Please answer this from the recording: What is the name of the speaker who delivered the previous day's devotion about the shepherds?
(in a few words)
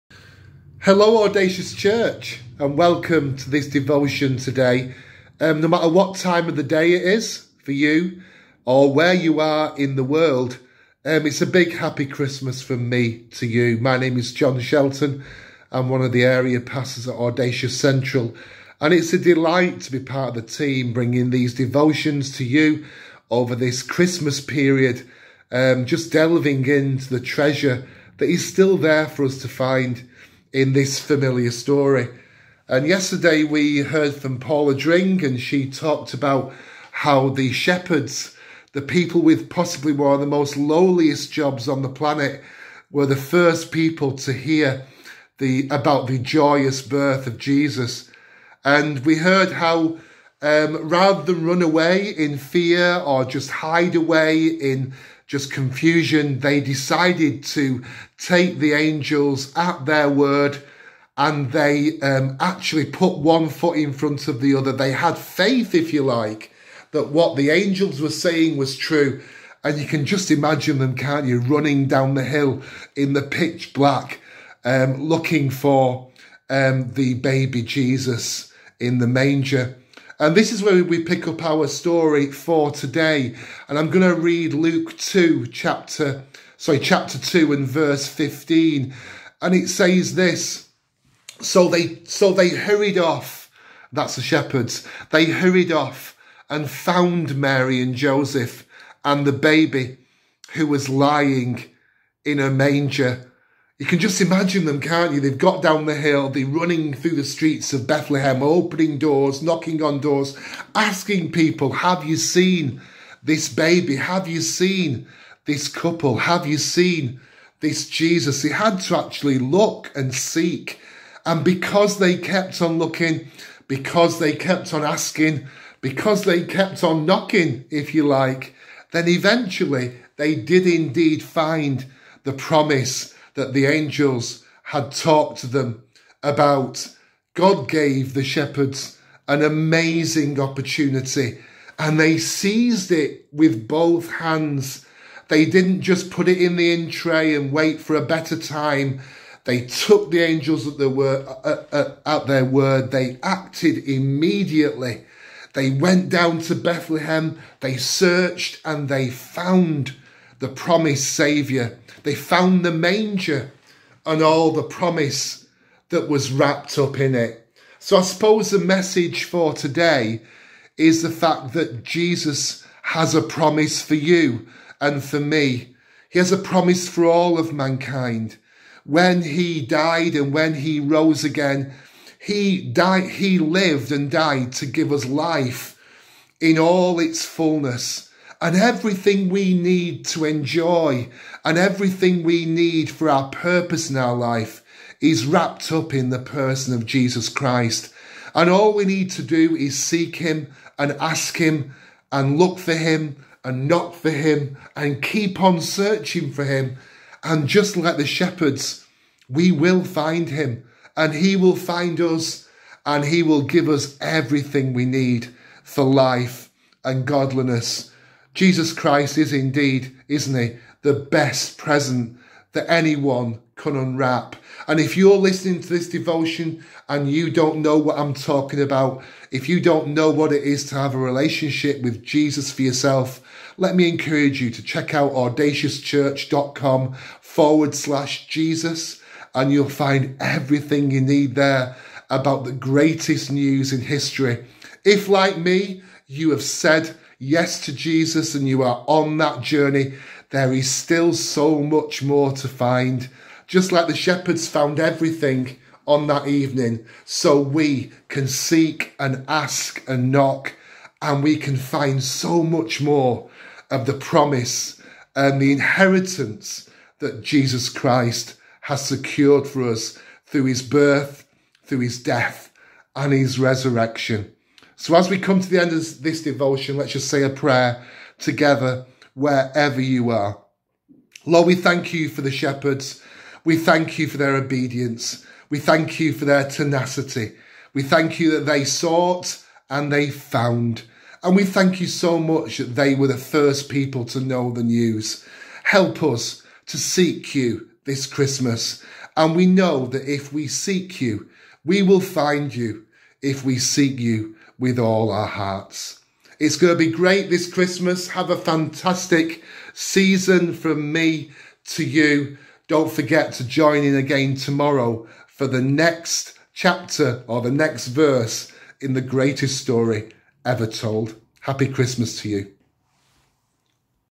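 Paula Dring.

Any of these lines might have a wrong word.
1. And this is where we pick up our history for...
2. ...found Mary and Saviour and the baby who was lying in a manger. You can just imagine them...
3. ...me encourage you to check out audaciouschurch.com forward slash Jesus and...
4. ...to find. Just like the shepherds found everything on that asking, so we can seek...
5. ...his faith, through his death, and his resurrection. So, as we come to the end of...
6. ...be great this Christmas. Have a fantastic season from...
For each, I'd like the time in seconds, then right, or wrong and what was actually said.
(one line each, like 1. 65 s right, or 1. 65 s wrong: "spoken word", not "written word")
1. 80 s wrong: "story", not "history"
2. 96 s wrong: "Joseph", not "Saviour"
3. 233 s right
4. 252 s wrong: "evening", not "asking"
5. 270 s wrong: "birth", not "faith"
6. 306 s right.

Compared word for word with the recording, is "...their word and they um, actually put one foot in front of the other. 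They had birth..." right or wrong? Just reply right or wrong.
wrong.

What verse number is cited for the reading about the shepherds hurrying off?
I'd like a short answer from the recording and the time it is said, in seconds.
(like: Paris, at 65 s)
15, at 88 s.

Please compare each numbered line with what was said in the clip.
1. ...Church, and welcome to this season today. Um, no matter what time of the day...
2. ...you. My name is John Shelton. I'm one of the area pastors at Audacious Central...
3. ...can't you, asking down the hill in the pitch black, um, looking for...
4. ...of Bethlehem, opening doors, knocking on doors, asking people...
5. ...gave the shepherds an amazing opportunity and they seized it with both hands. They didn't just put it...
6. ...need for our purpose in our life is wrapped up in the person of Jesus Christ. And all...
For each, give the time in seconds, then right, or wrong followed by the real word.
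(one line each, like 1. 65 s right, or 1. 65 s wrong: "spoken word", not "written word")
1. 1 s wrong: "devotion", not "season"
2. 13 s right
3. 70 s wrong: "running", not "asking"
4. 107 s right
5. 137 s right
6. 192 s right.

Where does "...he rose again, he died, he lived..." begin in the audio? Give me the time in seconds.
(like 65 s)
180 s.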